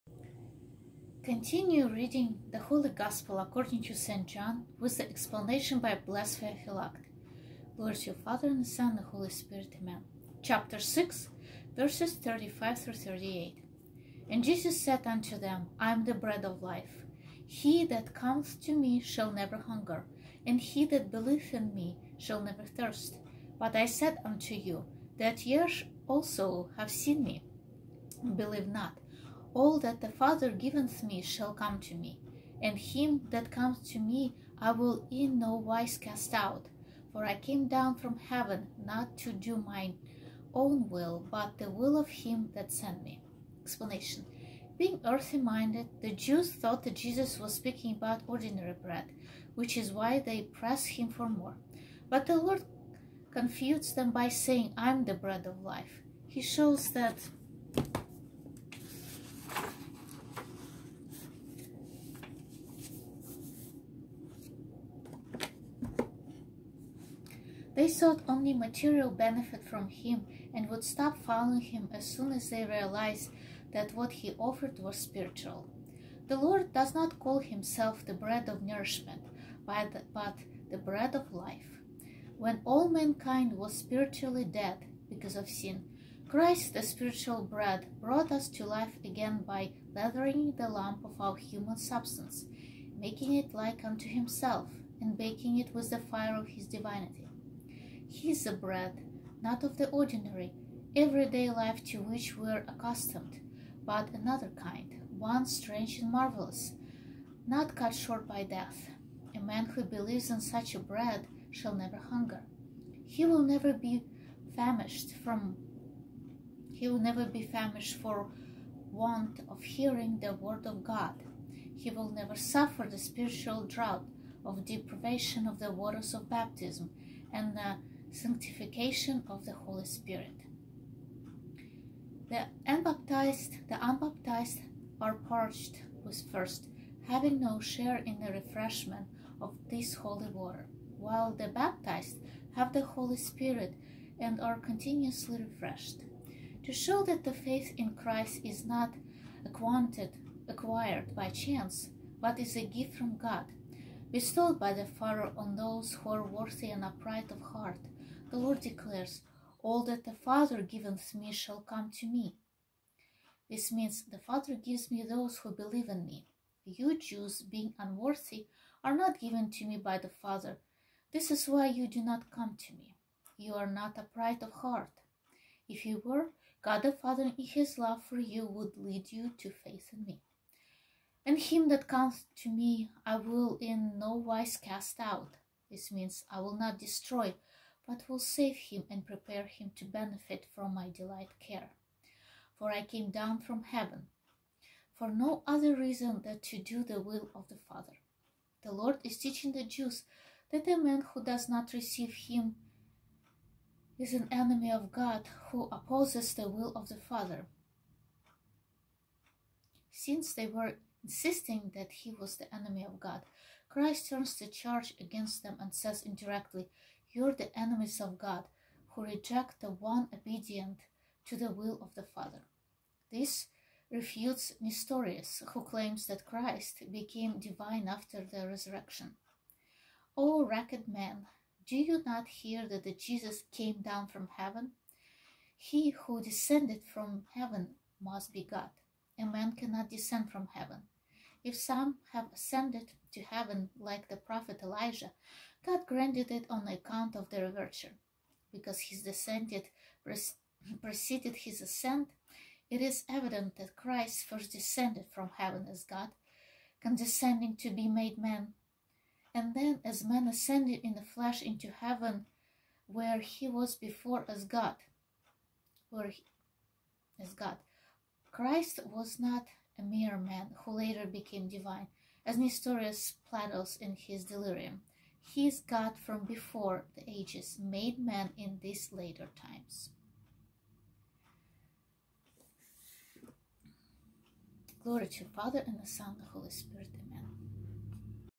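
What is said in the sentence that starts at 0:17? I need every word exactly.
He that cometh to me shall never hunger, and he that believeth in me shall never thirst.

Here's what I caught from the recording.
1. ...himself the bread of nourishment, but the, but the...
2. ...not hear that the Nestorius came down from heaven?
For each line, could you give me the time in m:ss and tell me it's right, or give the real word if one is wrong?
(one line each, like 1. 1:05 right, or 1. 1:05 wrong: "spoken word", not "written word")
1. 1:17 right
2. 3:52 wrong: "Jesus", not "Nestorius".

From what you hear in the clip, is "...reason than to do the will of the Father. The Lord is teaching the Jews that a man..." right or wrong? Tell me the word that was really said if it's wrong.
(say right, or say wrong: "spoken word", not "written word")
right.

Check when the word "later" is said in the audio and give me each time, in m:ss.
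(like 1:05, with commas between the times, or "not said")
4:30, 4:38.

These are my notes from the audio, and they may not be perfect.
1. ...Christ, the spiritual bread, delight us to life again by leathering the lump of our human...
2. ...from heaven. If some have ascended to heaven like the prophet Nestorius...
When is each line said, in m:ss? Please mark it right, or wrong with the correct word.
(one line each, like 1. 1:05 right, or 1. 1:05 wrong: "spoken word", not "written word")
1. 1:26 wrong: "brought", not "delight"
2. 4:00 wrong: "Elijah", not "Nestorius".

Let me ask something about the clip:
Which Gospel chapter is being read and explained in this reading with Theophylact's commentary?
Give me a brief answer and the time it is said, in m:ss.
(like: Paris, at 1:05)
Chapter 6, at 0:10.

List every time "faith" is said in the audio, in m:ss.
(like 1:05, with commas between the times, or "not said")
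2:27, 2:59.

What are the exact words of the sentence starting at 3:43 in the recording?
This refutes Nestorius, who claims that Christ became divine after the resurrection.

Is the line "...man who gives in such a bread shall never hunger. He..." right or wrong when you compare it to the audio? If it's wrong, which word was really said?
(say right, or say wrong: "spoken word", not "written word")
wrong: "believes", not "gives".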